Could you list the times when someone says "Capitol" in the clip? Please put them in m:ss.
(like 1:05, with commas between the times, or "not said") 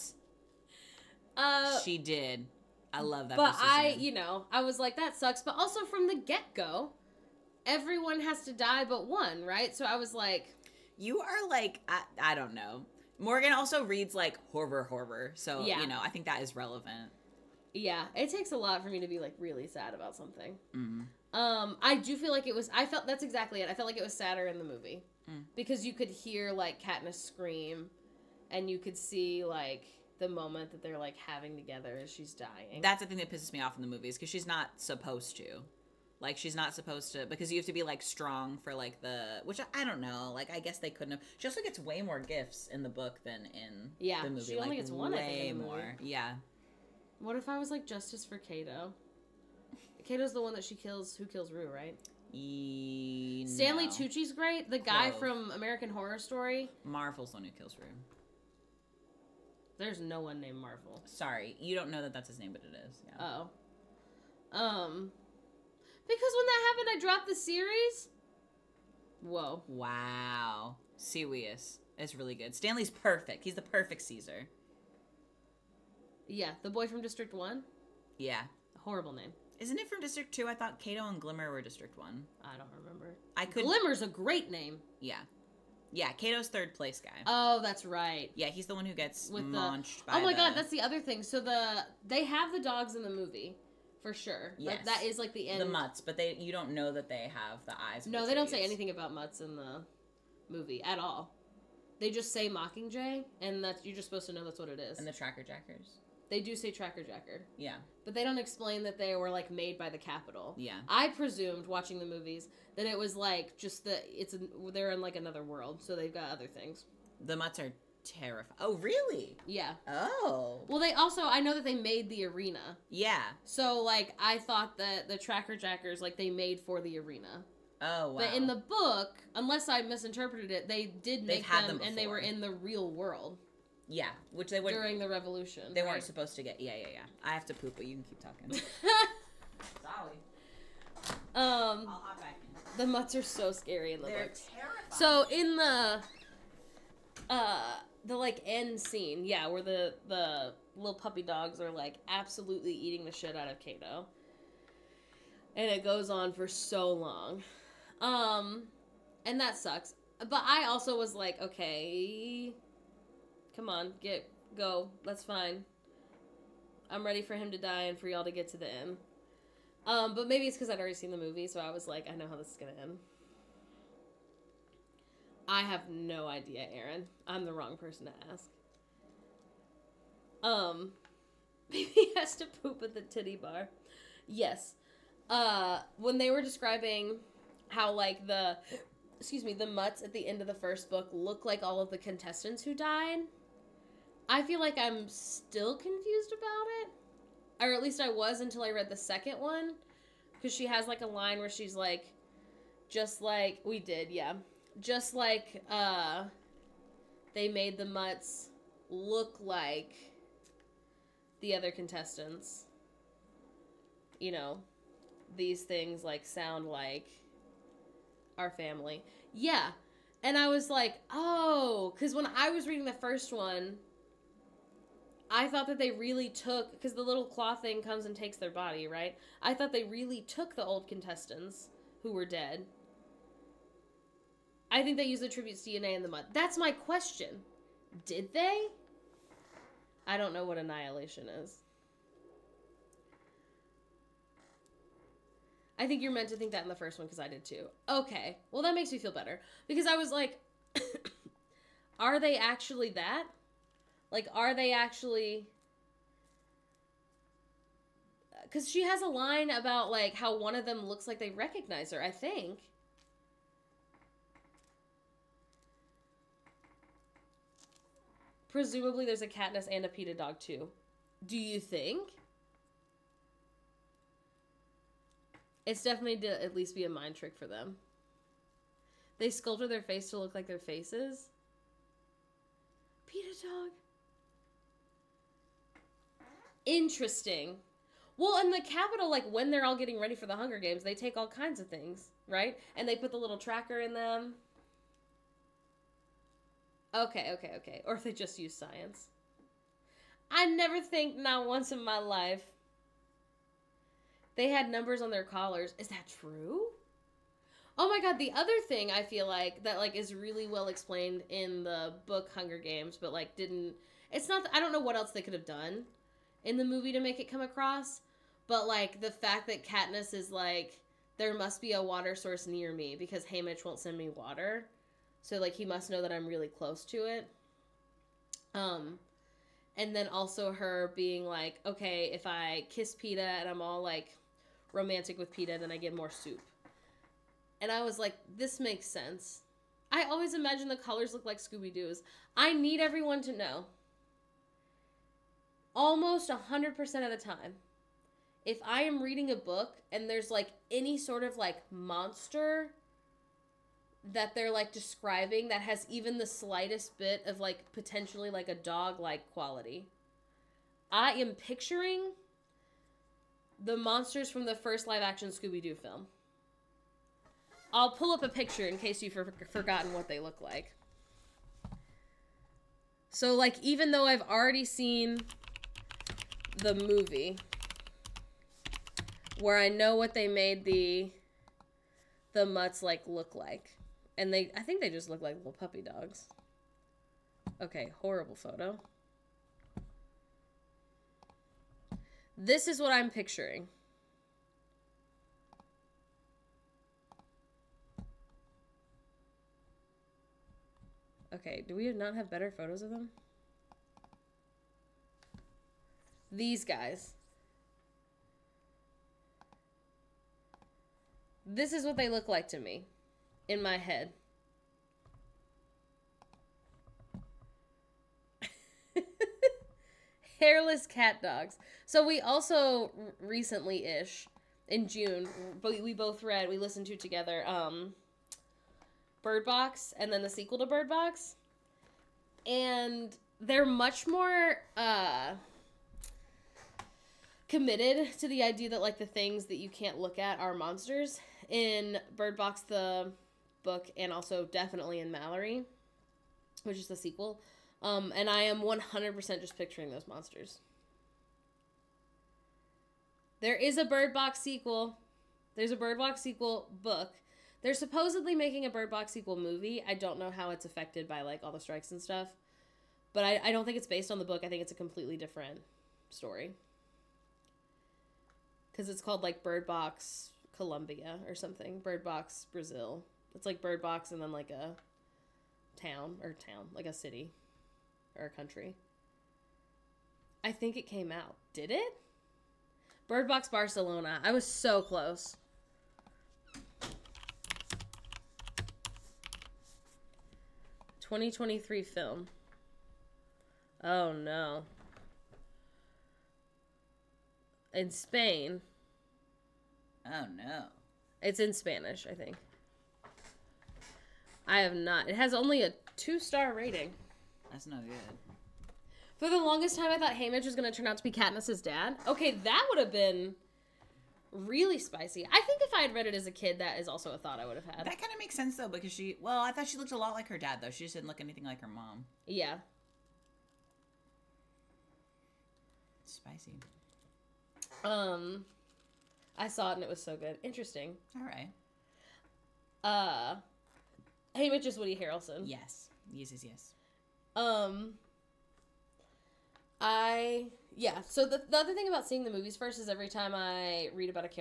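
1:49, 4:48.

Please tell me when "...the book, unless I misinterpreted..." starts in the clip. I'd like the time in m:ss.
2:08.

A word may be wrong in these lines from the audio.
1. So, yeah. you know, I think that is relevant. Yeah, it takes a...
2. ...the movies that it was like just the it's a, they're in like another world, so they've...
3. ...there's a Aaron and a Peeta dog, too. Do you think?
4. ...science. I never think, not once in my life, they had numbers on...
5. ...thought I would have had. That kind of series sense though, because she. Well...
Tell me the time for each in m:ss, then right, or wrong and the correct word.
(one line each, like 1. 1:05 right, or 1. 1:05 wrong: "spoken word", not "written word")
1. 0:15 right
2. 1:51 right
3. 4:29 wrong: "Katniss", not "Aaron"
4. 4:58 right
5. 8:37 wrong: "makes", not "series".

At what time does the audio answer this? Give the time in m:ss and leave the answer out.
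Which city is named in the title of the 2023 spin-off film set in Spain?
8:03.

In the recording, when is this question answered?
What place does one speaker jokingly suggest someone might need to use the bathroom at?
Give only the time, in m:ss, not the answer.
3:02.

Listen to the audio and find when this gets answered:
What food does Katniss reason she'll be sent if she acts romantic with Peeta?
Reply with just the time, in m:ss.
5:35.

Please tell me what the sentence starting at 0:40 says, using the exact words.
Like I guess they couldn't have.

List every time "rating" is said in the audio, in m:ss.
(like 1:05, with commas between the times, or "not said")
8:26.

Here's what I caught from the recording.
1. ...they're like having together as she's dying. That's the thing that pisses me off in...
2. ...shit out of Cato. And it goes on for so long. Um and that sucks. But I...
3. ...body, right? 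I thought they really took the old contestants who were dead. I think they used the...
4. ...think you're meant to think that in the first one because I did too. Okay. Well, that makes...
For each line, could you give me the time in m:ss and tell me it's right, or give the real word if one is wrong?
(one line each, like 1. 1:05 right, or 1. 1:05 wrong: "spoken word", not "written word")
1. 0:30 right
2. 2:33 right
3. 3:48 right
4. 4:05 right.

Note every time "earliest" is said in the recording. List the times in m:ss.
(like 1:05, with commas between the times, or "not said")
not said.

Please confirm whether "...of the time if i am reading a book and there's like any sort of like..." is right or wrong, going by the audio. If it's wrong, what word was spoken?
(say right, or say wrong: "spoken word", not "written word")
right.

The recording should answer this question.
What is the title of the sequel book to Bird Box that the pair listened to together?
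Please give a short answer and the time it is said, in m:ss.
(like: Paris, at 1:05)
Mallory, at 7:25.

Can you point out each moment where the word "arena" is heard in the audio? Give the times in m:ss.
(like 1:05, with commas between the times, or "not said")
2:02, 2:06.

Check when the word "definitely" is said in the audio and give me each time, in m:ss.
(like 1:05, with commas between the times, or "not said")
4:35, 7:24.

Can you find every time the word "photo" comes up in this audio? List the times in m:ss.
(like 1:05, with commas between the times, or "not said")
6:28, 6:42.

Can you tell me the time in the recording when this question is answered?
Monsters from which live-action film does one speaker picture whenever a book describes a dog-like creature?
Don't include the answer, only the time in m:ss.
6:05.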